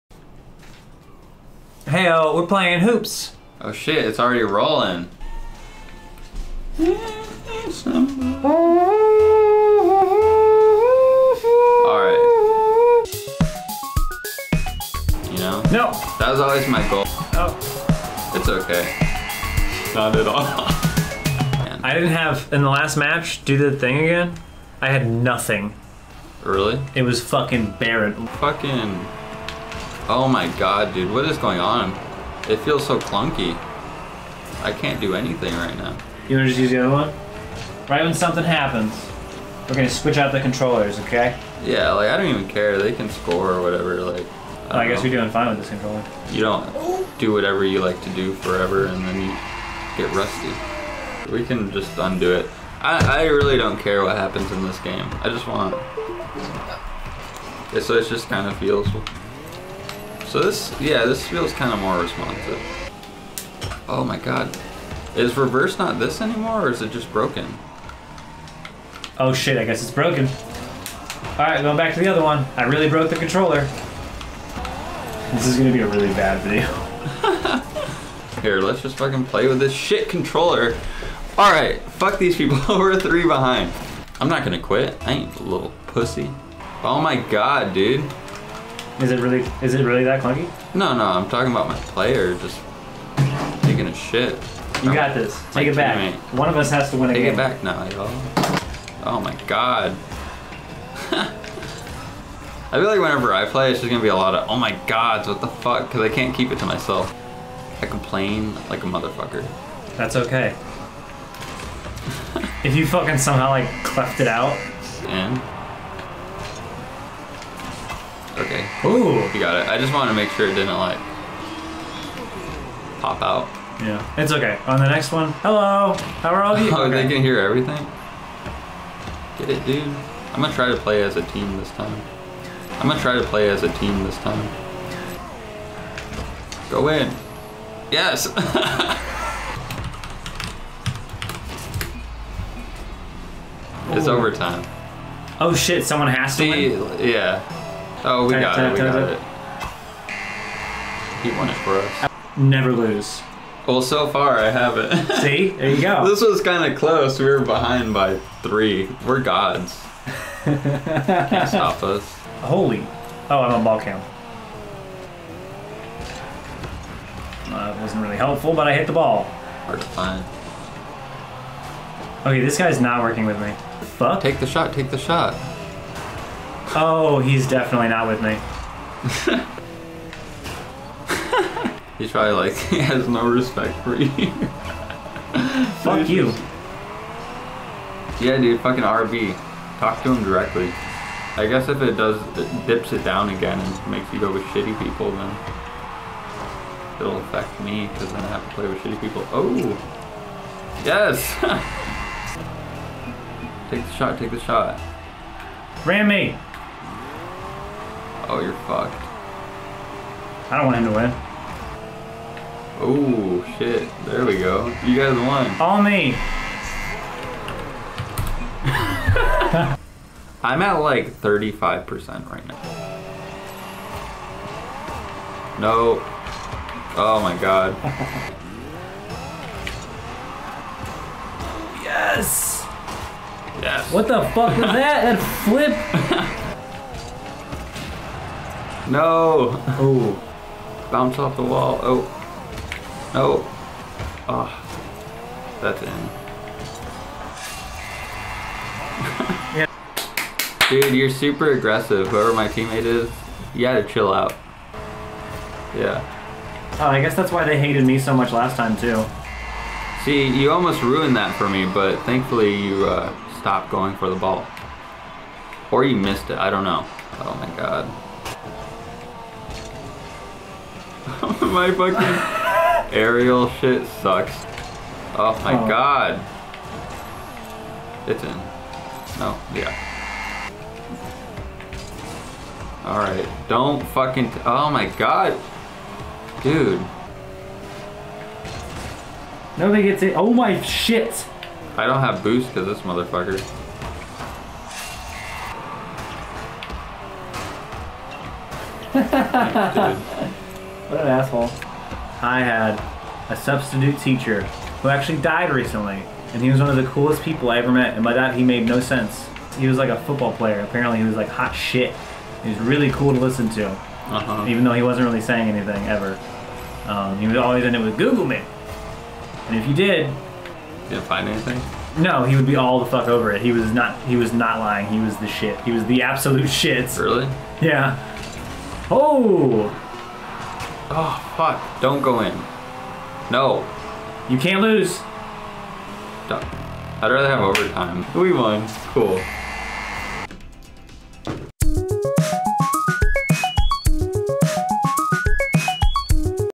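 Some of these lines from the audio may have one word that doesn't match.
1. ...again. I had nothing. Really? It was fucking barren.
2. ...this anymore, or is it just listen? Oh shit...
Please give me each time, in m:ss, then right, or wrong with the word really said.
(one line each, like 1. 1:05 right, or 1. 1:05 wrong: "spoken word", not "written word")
1. 0:23 right
2. 1:05 wrong: "broken", not "listen".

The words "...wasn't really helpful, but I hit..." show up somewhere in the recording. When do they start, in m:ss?
2:47.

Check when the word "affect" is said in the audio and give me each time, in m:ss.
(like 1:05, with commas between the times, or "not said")
3:17.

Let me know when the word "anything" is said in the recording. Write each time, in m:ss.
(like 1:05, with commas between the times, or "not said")
0:35, 5:15, 5:21.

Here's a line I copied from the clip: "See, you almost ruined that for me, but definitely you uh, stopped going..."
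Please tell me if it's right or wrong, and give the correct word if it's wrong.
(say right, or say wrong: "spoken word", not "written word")
wrong: "thankfully", not "definitely".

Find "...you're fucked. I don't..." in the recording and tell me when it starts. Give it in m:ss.
3:28.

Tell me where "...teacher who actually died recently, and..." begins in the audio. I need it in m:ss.
5:04.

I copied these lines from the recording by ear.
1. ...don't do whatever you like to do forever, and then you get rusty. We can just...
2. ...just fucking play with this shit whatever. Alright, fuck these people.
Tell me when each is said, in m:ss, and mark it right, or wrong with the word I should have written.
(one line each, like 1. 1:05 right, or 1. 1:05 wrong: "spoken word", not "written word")
1. 0:46 right
2. 1:18 wrong: "controller", not "whatever".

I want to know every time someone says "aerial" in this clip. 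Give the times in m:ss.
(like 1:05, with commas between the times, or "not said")
4:32.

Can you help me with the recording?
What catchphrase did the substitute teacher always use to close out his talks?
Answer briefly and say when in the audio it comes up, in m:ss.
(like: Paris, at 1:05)
Google me, at 5:17.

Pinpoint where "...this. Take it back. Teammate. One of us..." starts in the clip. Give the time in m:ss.
1:35.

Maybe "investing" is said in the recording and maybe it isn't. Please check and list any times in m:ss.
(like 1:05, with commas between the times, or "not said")
not said.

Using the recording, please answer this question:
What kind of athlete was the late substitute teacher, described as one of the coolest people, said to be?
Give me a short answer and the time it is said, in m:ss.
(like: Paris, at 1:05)
football player, at 5:10.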